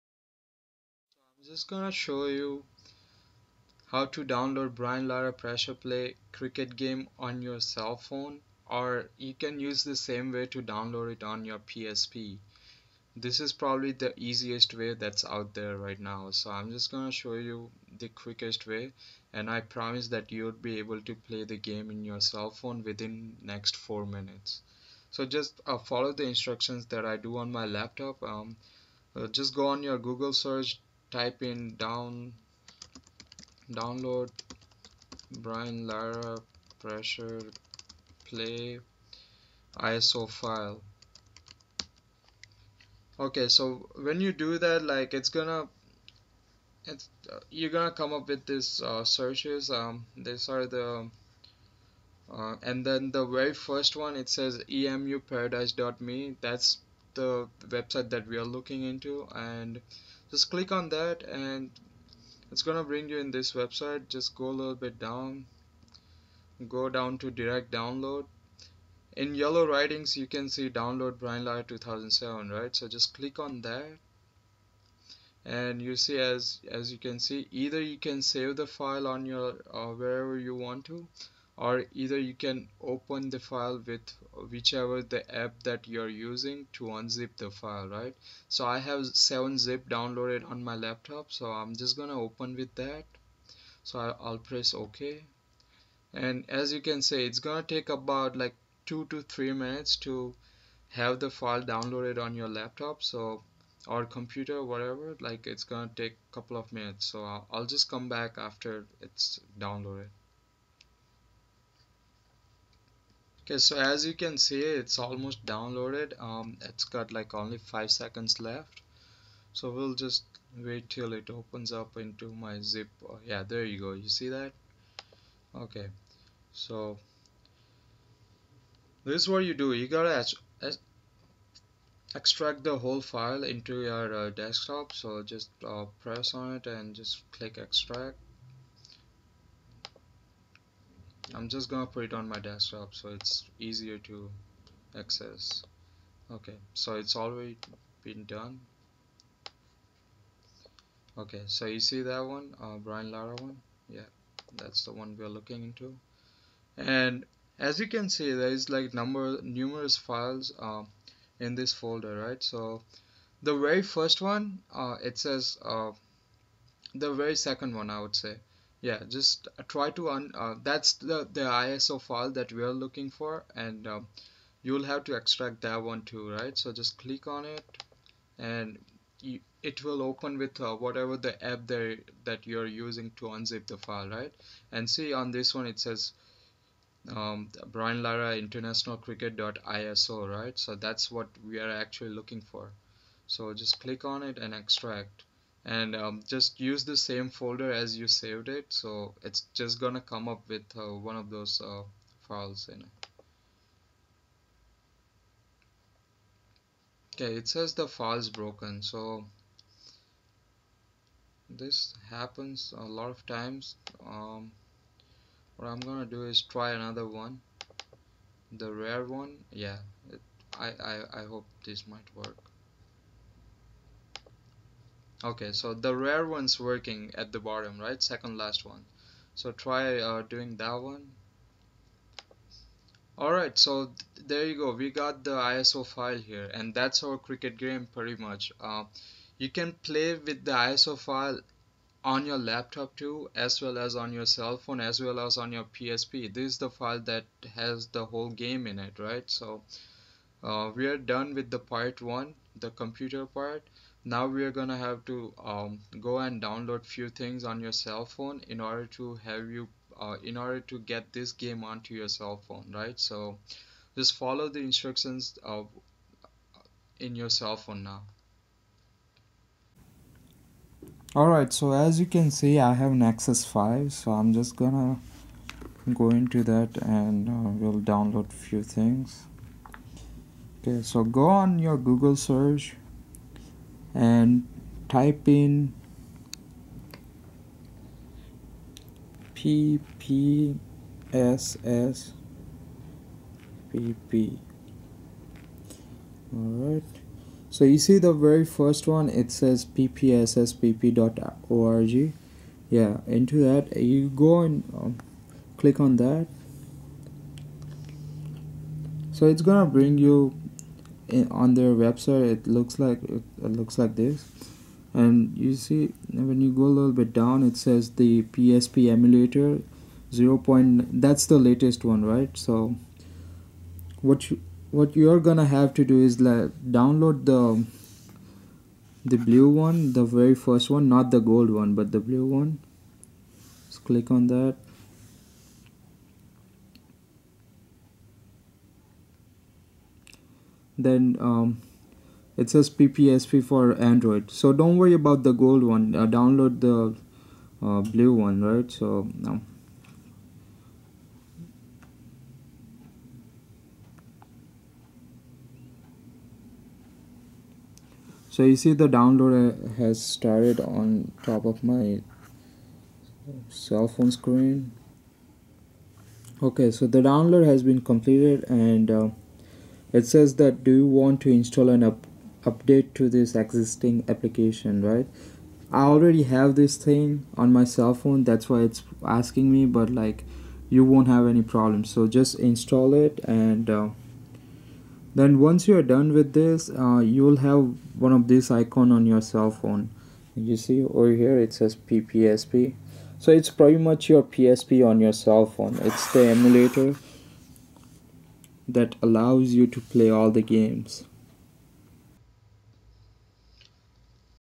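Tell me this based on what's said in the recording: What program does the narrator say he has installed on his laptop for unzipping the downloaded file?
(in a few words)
7zip.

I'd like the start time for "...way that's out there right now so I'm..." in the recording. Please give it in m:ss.
0:14.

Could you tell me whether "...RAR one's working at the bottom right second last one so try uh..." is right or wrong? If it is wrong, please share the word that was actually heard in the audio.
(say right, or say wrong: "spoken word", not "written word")
right.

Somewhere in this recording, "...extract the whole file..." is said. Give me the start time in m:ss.
2:12.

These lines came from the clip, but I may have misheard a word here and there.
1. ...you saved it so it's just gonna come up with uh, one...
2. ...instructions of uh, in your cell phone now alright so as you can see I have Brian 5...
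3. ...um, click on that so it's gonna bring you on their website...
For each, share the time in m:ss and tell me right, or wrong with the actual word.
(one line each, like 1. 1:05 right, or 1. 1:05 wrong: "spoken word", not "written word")
1. 3:17 right
2. 4:24 wrong: "Nexus", not "Brian"
3. 5:04 right.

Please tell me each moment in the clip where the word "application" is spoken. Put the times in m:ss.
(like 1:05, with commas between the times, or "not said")
6:14.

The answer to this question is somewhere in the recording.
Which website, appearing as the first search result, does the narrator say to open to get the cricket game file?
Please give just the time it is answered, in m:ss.
0:54.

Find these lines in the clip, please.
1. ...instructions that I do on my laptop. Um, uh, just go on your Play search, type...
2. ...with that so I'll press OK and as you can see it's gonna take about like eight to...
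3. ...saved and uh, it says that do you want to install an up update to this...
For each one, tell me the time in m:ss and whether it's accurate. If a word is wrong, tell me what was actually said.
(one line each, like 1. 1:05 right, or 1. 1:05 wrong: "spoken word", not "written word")
1. 0:26 wrong: "Google", not "Play"
2. 1:32 wrong: "two", not "eight"
3. 6:07 wrong: "completed", not "saved".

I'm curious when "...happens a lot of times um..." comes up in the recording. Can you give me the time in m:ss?
3:32.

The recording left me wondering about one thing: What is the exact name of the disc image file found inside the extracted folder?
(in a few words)
Brian Lara international cricket.iso.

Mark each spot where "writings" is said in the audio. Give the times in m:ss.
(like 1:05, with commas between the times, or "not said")
1:09.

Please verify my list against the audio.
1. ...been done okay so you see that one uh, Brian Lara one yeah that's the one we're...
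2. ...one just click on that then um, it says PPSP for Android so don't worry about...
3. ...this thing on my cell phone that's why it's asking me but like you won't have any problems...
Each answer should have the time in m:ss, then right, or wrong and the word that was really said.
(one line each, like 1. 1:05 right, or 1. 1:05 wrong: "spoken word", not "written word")
1. 2:28 right
2. 5:32 right
3. 6:16 right.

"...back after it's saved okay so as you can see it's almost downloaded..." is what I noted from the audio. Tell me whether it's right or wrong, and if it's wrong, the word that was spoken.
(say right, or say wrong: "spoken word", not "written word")
wrong: "downloaded", not "saved".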